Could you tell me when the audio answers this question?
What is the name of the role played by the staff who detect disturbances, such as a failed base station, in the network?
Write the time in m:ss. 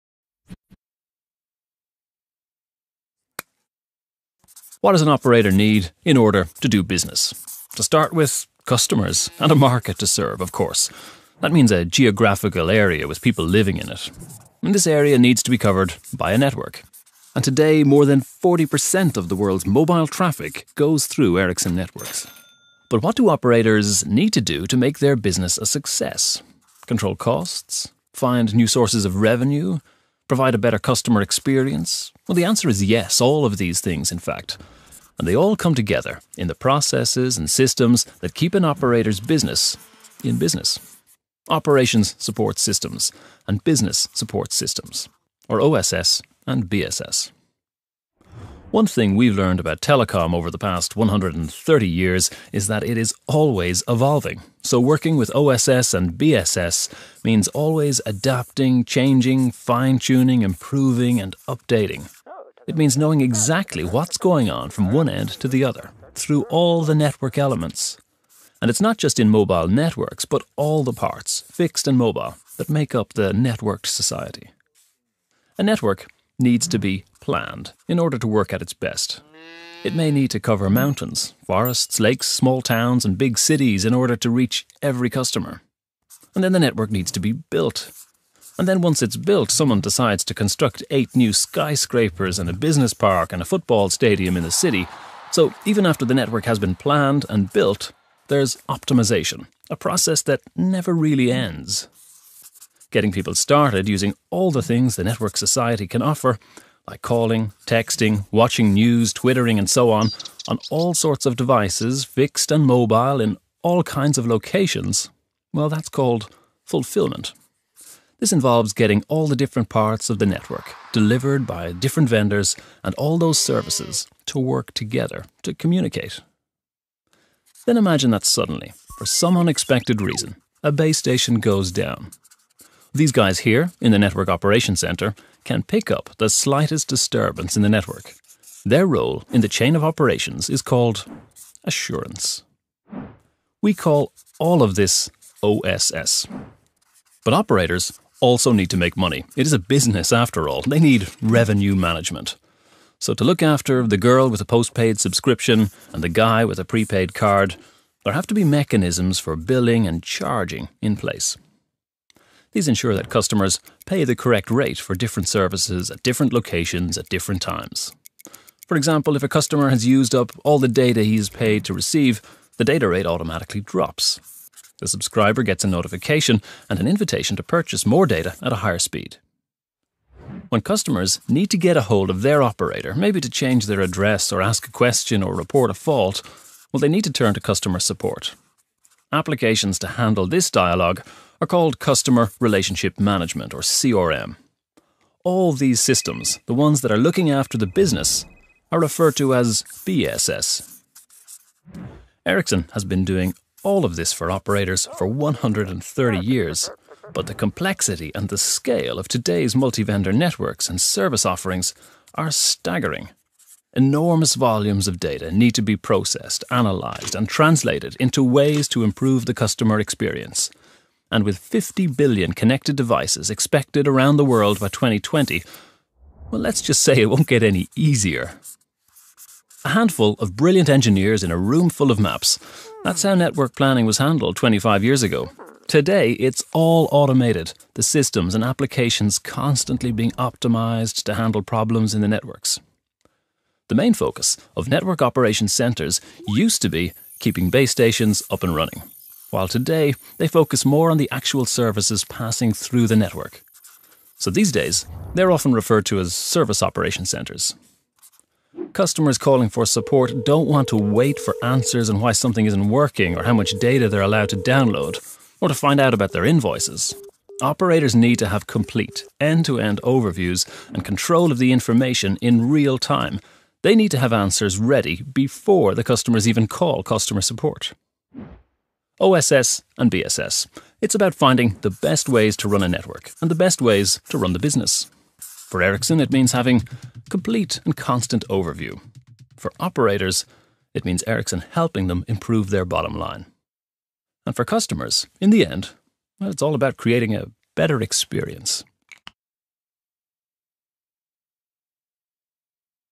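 2:21.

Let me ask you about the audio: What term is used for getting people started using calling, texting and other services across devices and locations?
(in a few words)
Fulfillment.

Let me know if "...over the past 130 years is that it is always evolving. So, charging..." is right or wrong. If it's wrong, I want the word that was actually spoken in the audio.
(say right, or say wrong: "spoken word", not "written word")
wrong: "working", not "charging".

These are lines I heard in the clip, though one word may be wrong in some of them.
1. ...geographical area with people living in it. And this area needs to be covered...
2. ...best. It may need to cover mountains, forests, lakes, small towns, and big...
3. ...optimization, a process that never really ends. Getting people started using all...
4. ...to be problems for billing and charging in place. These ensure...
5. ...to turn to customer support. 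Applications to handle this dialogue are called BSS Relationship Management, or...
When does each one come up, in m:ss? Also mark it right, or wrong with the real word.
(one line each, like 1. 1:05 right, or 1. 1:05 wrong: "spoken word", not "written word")
1. 0:11 right
2. 1:18 right
3. 1:38 right
4. 2:38 wrong: "mechanisms", not "problems"
5. 3:07 wrong: "Customer", not "BSS".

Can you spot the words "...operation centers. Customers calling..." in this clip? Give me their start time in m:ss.
4:16.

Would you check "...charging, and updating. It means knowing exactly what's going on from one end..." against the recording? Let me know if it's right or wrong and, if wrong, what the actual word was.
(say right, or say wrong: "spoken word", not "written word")
wrong: "improving", not "charging".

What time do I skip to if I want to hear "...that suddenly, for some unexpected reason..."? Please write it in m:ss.
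2:08.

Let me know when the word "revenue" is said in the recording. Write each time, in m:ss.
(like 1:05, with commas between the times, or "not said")
0:29, 2:31.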